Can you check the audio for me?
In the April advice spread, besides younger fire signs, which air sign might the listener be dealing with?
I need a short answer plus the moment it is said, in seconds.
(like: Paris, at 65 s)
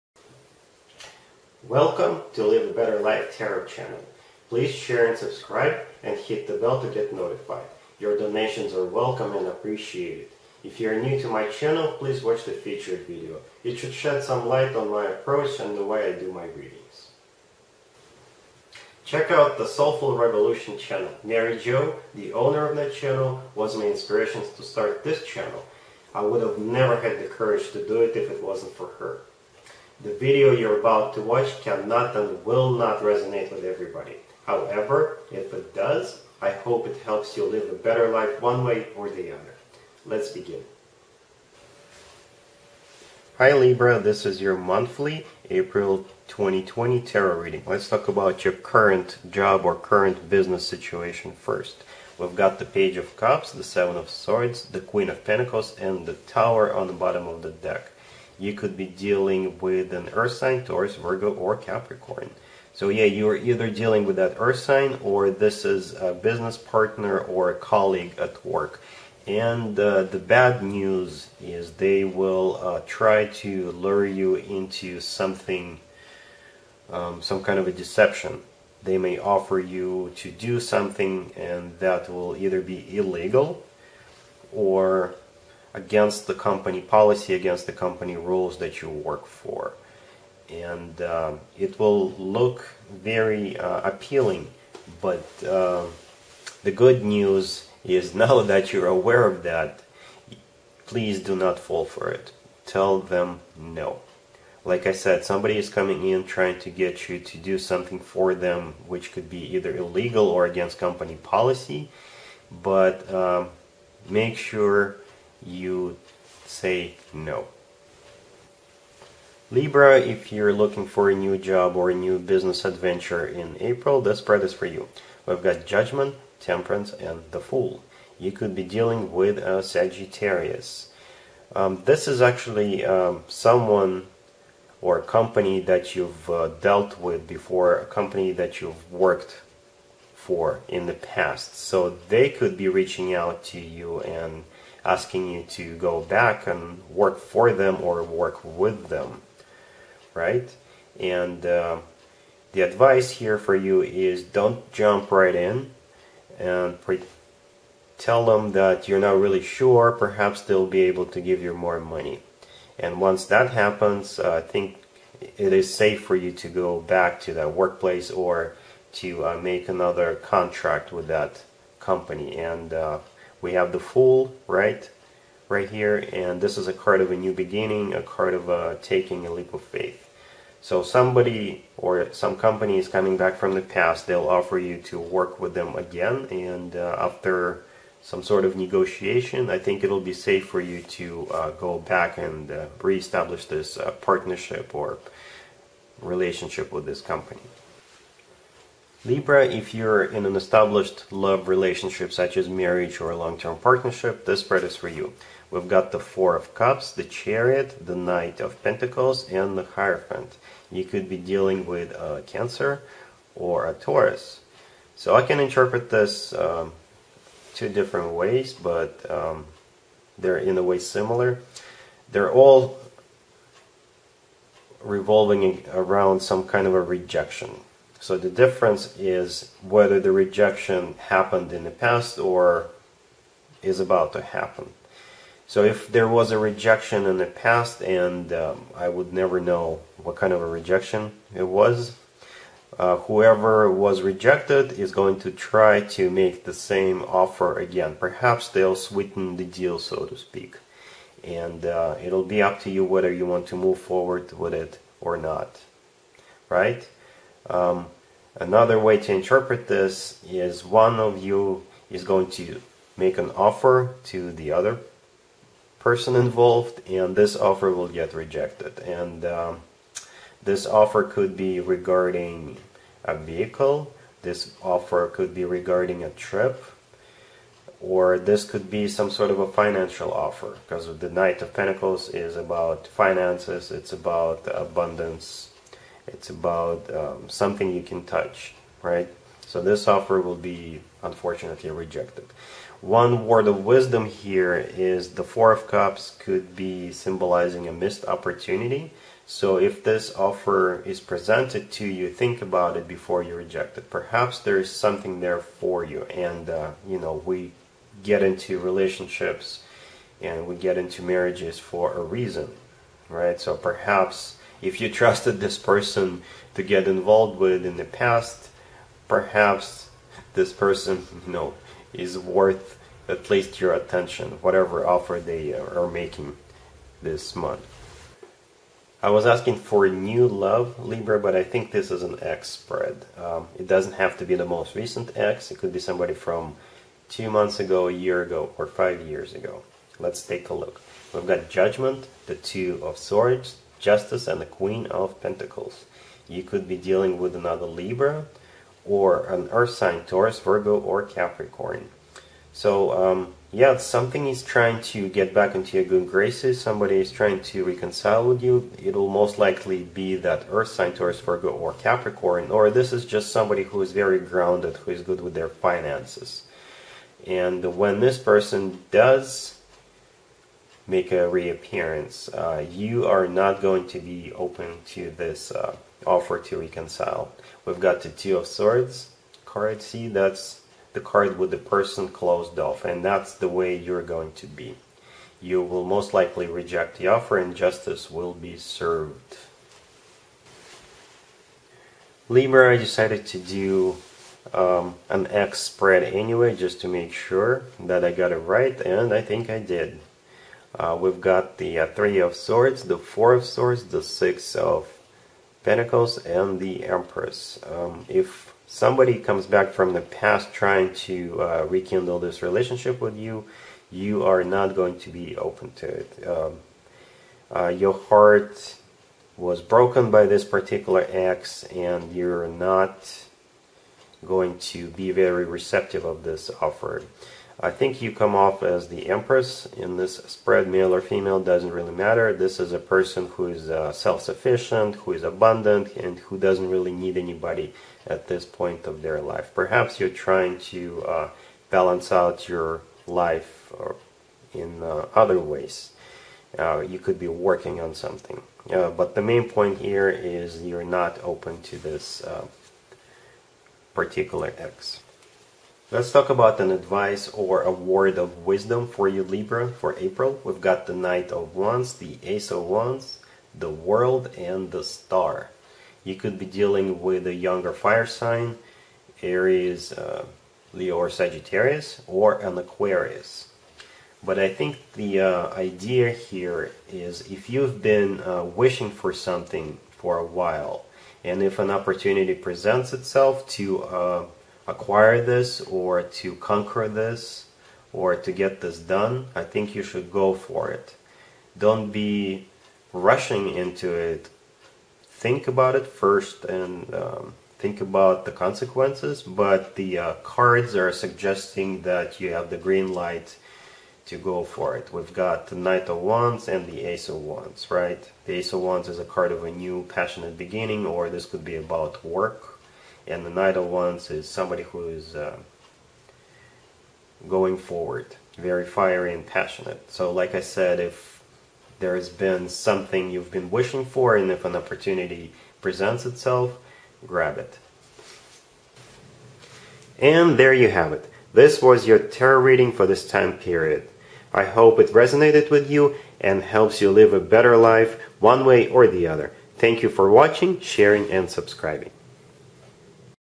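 Aquarius, at 472 s.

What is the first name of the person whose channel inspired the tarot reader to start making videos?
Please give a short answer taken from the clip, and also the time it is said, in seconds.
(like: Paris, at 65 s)
Mary Jo, at 21 s.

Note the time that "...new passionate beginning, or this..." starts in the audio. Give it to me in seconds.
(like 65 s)
509 s.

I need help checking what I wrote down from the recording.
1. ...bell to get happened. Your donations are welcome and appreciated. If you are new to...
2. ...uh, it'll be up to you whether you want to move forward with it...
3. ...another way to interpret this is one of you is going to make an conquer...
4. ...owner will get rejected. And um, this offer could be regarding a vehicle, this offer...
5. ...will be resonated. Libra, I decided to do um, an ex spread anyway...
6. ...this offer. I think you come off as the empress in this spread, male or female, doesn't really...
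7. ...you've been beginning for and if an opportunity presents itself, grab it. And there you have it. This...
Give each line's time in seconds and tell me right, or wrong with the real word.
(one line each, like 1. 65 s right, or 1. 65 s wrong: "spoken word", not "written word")
1. 6 s wrong: "notified", not "happened"
2. 251 s right
3. 258 s wrong: "offer", not "conquer"
4. 267 s wrong: "offer", not "owner"
5. 388 s wrong: "served", not "resonated"
6. 426 s right
7. 523 s wrong: "wishing", not "beginning".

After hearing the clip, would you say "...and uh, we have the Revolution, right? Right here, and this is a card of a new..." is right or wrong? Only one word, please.
wrong.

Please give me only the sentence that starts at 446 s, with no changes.
Uh, you could be working on something.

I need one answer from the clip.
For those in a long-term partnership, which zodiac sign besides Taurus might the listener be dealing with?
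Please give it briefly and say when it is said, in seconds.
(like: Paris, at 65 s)
Cancer, at 212 s.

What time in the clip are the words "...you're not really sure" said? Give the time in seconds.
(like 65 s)
158 s.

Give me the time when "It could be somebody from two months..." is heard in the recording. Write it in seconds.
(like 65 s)
335 s.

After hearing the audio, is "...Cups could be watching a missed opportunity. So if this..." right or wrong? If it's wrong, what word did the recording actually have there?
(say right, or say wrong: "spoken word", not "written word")
wrong: "symbolizing", not "watching".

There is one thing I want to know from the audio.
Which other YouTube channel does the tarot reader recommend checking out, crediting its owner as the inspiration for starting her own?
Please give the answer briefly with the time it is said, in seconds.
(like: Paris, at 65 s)
Soulful Revolution, at 19 s.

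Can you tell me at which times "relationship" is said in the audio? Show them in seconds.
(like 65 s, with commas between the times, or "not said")
196 s, 201 s, 308 s, 412 s.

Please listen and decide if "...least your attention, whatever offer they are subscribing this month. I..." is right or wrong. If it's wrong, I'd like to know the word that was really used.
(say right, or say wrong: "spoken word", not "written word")
wrong: "making", not "subscribing".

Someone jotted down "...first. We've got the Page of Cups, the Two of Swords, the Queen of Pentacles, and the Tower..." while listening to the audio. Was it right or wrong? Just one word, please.
wrong.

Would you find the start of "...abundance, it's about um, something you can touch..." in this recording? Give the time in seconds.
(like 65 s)
284 s.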